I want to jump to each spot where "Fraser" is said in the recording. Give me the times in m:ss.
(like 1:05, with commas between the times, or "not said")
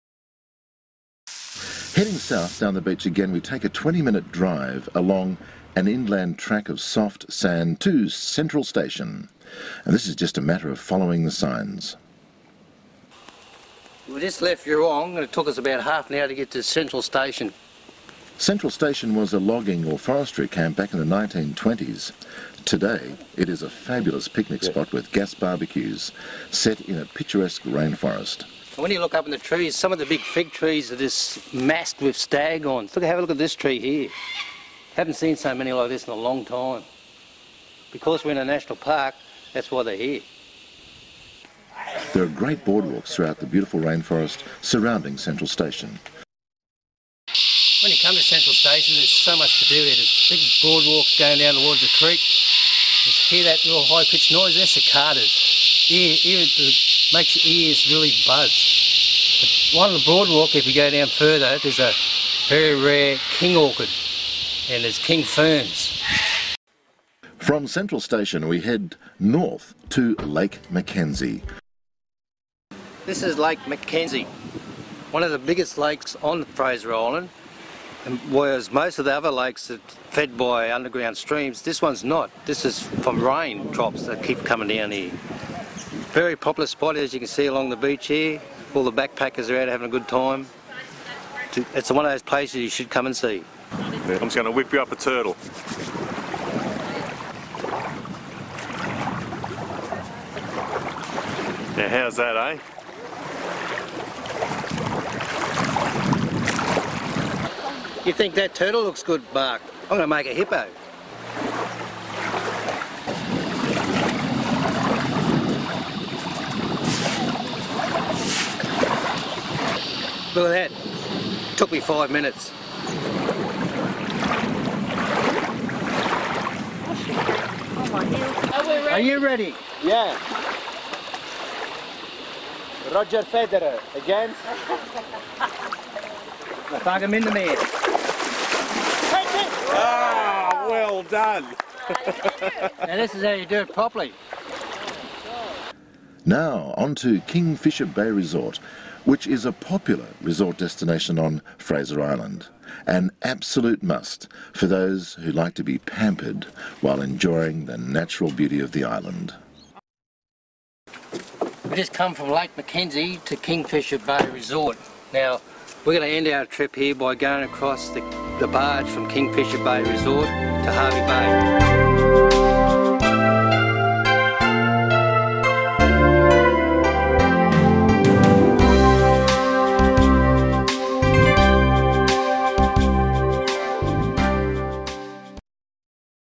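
1:16, 2:31.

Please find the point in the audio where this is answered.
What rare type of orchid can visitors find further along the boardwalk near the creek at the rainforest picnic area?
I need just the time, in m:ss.
1:03.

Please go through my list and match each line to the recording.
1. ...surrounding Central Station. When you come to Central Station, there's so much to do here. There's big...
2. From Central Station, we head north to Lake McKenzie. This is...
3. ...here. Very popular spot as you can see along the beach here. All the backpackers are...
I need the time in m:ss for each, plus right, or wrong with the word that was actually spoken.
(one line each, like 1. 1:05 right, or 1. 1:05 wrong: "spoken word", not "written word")
1. 0:44 right
2. 1:07 right
3. 1:24 right.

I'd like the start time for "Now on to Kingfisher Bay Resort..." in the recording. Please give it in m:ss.
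2:26.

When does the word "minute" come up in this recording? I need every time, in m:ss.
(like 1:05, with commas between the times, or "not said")
0:04, 2:02.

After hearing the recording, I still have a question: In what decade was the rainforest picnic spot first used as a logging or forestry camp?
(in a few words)
1920s.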